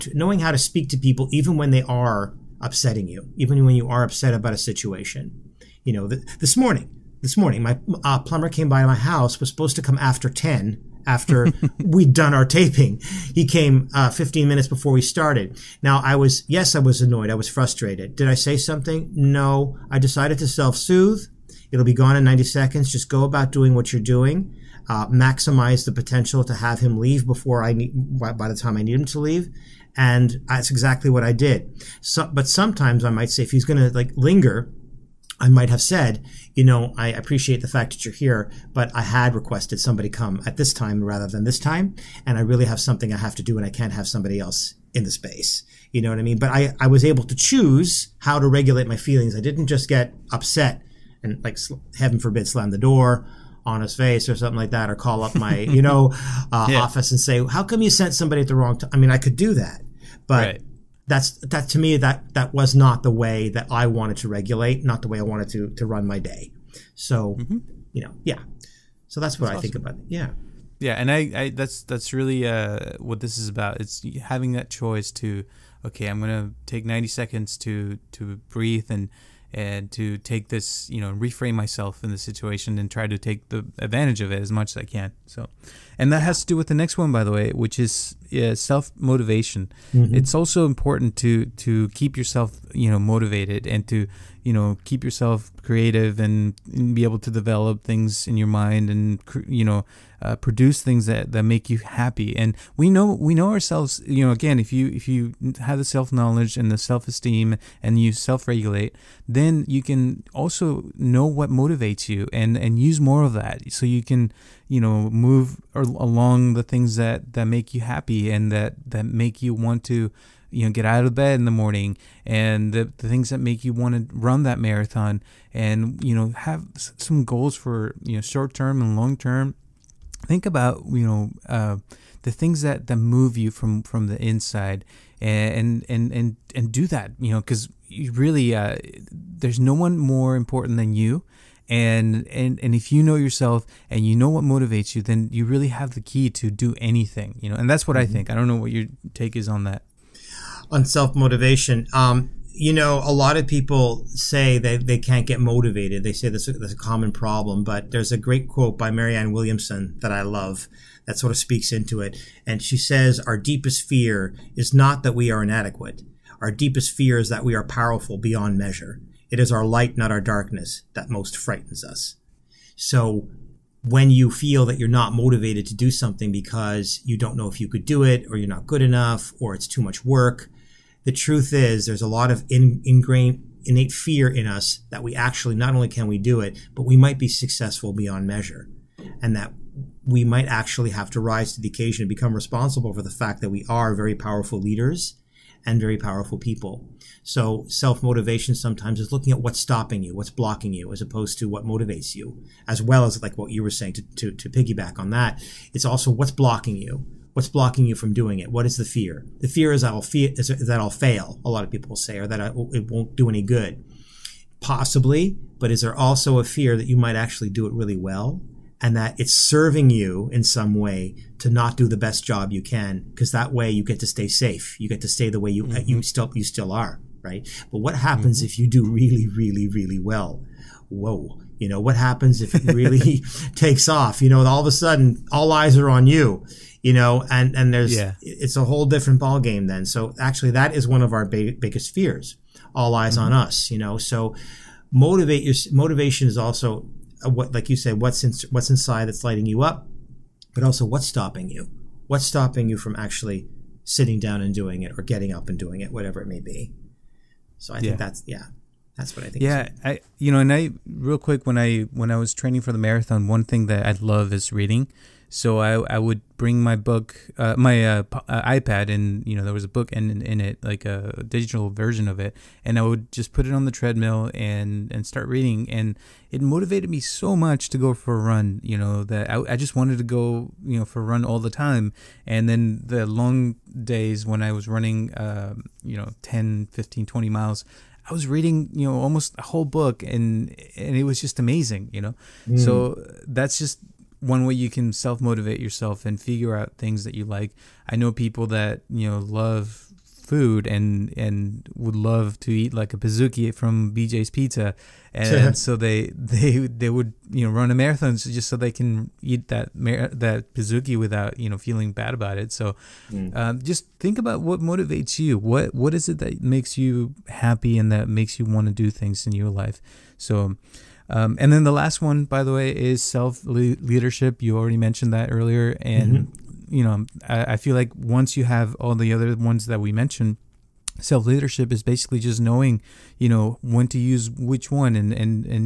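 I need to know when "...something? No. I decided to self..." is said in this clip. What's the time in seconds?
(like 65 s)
18 s.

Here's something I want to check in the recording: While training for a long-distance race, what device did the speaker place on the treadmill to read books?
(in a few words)
iPad.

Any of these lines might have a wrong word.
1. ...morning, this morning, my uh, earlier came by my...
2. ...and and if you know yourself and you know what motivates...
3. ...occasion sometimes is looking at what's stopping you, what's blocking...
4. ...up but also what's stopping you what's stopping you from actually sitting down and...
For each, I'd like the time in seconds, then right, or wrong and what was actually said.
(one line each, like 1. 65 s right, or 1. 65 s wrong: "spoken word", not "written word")
1. 6 s wrong: "plumber", not "earlier"
2. 142 s right
3. 198 s wrong: "motivation", not "occasion"
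4. 249 s right.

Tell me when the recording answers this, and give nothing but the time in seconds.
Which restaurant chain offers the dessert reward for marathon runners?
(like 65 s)
303 s.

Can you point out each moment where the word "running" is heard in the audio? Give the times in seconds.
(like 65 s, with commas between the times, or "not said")
284 s.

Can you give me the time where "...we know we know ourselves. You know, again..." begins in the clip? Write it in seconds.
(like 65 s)
102 s.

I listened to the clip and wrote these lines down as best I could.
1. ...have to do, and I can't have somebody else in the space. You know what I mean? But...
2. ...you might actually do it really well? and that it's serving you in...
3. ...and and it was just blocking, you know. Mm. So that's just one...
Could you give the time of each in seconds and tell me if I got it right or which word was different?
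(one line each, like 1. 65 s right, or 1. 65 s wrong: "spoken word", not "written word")
1. 43 s right
2. 216 s right
3. 290 s wrong: "amazing", not "blocking".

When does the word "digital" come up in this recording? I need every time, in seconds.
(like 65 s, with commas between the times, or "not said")
271 s.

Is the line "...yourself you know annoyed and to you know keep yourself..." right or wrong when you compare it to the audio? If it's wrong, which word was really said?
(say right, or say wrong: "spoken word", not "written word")
wrong: "motivated", not "annoyed".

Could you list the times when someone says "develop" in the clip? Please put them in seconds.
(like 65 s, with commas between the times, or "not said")
97 s.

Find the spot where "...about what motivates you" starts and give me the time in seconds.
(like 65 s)
314 s.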